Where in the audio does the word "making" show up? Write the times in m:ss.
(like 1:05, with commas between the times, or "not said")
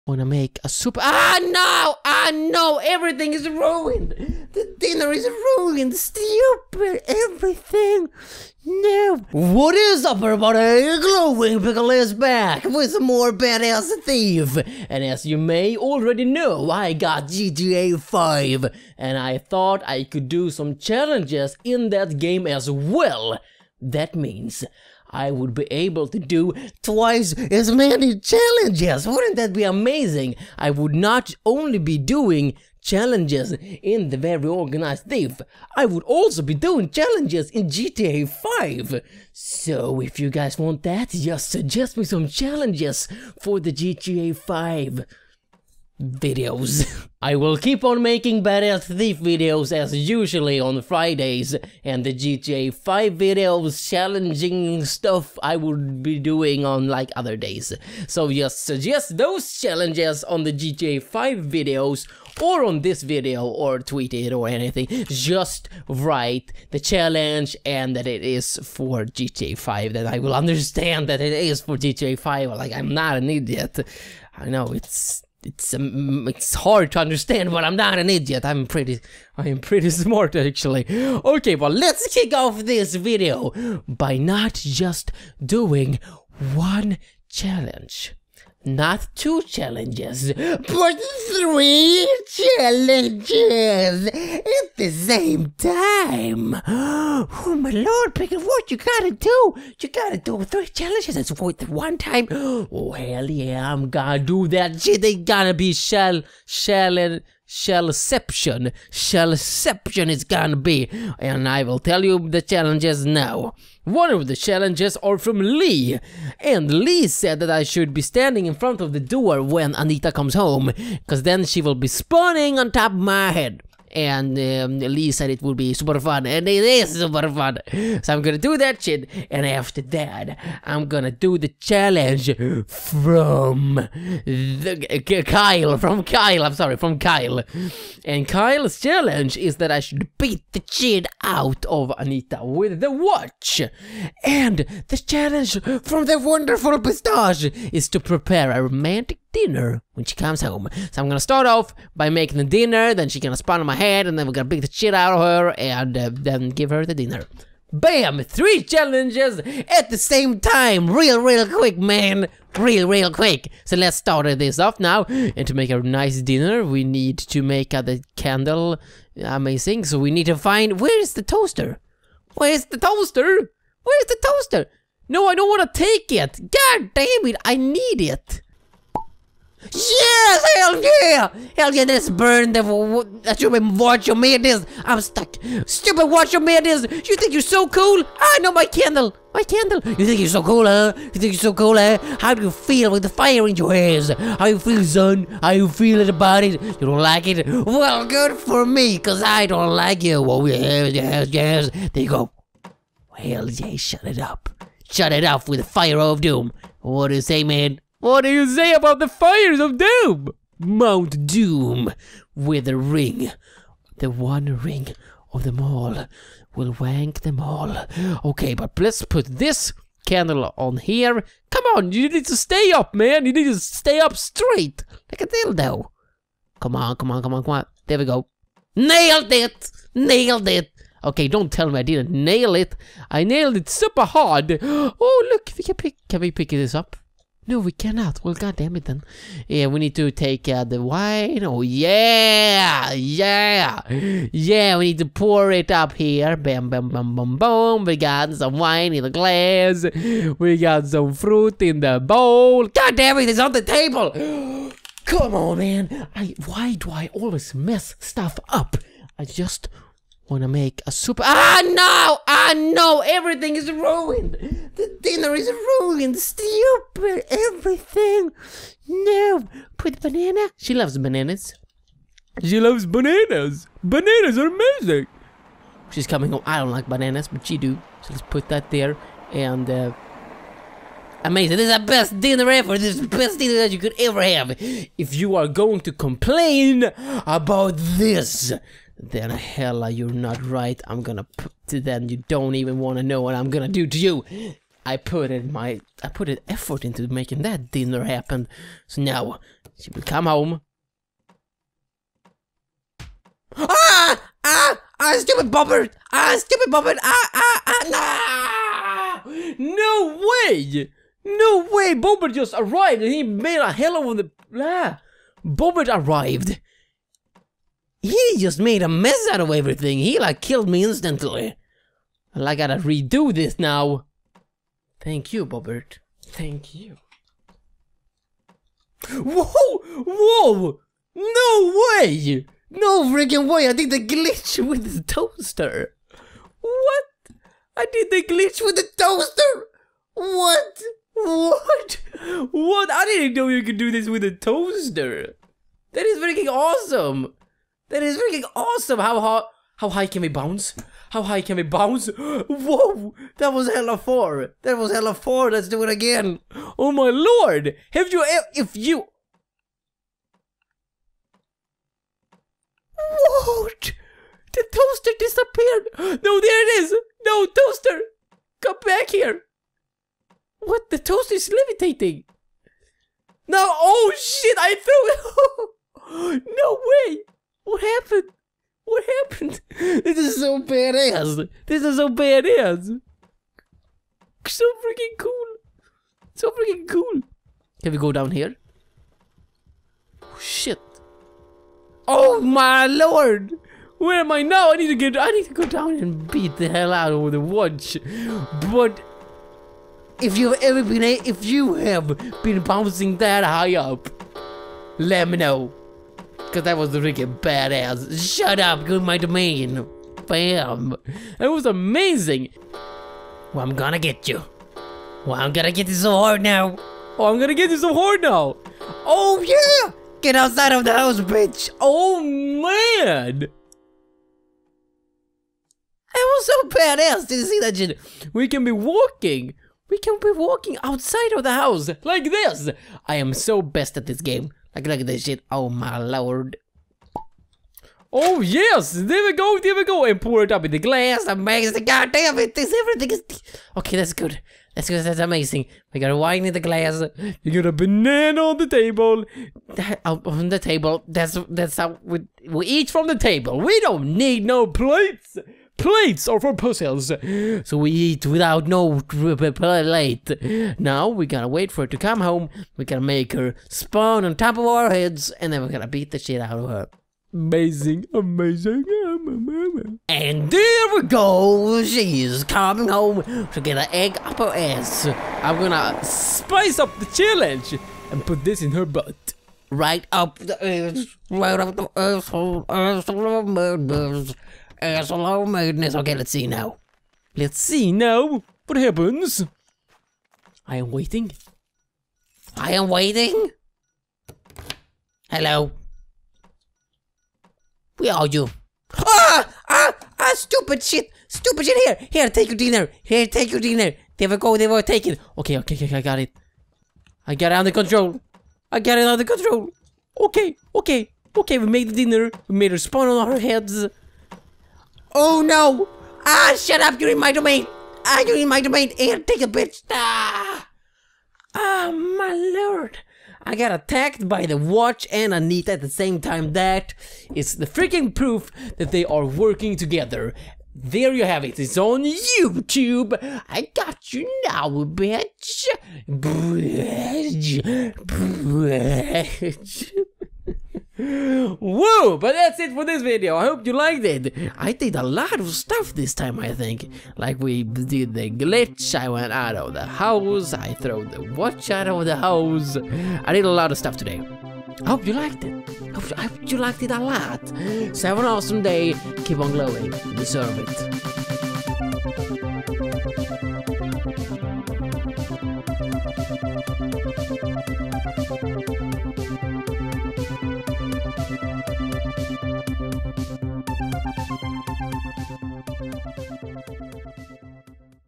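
0:48, 2:32, 4:57.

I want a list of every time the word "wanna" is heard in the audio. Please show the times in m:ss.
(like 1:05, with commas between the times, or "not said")
0:00, 4:20, 4:52.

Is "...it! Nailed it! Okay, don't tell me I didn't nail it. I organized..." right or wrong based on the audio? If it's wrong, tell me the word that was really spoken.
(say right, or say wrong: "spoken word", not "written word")
wrong: "nailed", not "organized".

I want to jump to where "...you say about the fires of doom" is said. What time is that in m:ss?
3:28.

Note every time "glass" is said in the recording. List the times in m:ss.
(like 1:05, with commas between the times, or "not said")
4:09, 7:20, 7:26.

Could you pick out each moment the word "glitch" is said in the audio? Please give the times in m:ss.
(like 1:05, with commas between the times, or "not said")
5:34, 5:38, 9:08.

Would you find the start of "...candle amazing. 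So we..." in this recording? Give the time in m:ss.
2:48.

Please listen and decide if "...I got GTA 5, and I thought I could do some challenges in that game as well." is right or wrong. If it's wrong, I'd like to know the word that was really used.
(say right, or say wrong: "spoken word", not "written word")
right.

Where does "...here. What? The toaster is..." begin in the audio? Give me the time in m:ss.
6:09.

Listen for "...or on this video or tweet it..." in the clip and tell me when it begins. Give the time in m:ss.
1:02.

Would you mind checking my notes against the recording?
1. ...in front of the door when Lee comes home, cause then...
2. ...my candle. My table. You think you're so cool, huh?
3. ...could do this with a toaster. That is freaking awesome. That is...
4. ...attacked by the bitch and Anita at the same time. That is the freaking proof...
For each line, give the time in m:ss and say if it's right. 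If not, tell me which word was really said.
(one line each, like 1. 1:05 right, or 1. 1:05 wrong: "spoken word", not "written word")
1. 1:58 wrong: "Anita", not "Lee"
2. 3:08 wrong: "candle", not "table"
3. 5:43 right
4. 8:43 wrong: "watch", not "bitch".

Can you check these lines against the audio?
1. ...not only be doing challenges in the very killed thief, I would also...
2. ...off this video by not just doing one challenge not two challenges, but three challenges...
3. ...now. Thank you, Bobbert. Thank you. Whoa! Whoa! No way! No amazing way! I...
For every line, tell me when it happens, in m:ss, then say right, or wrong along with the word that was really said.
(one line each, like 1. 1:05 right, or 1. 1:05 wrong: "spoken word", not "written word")
1. 0:30 wrong: "organized", not "killed"
2. 1:22 right
3. 5:23 wrong: "freaking", not "amazing".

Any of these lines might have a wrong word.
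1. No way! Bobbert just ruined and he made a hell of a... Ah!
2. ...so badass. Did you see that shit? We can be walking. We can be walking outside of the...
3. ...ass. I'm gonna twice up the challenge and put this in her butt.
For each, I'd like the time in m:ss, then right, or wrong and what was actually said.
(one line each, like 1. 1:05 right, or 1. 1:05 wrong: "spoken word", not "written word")
1. 5:11 wrong: "arrived", not "ruined"
2. 7:06 right
3. 7:54 wrong: "spice", not "twice".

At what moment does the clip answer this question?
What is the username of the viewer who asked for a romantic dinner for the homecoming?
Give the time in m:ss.
2:26.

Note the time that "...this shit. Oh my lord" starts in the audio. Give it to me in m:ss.
7:15.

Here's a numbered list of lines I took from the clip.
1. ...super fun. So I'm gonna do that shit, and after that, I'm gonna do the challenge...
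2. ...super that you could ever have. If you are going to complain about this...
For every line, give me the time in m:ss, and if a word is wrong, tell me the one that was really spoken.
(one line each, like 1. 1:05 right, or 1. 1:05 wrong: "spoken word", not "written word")
1. 2:06 right
2. 4:43 wrong: "dinner", not "super".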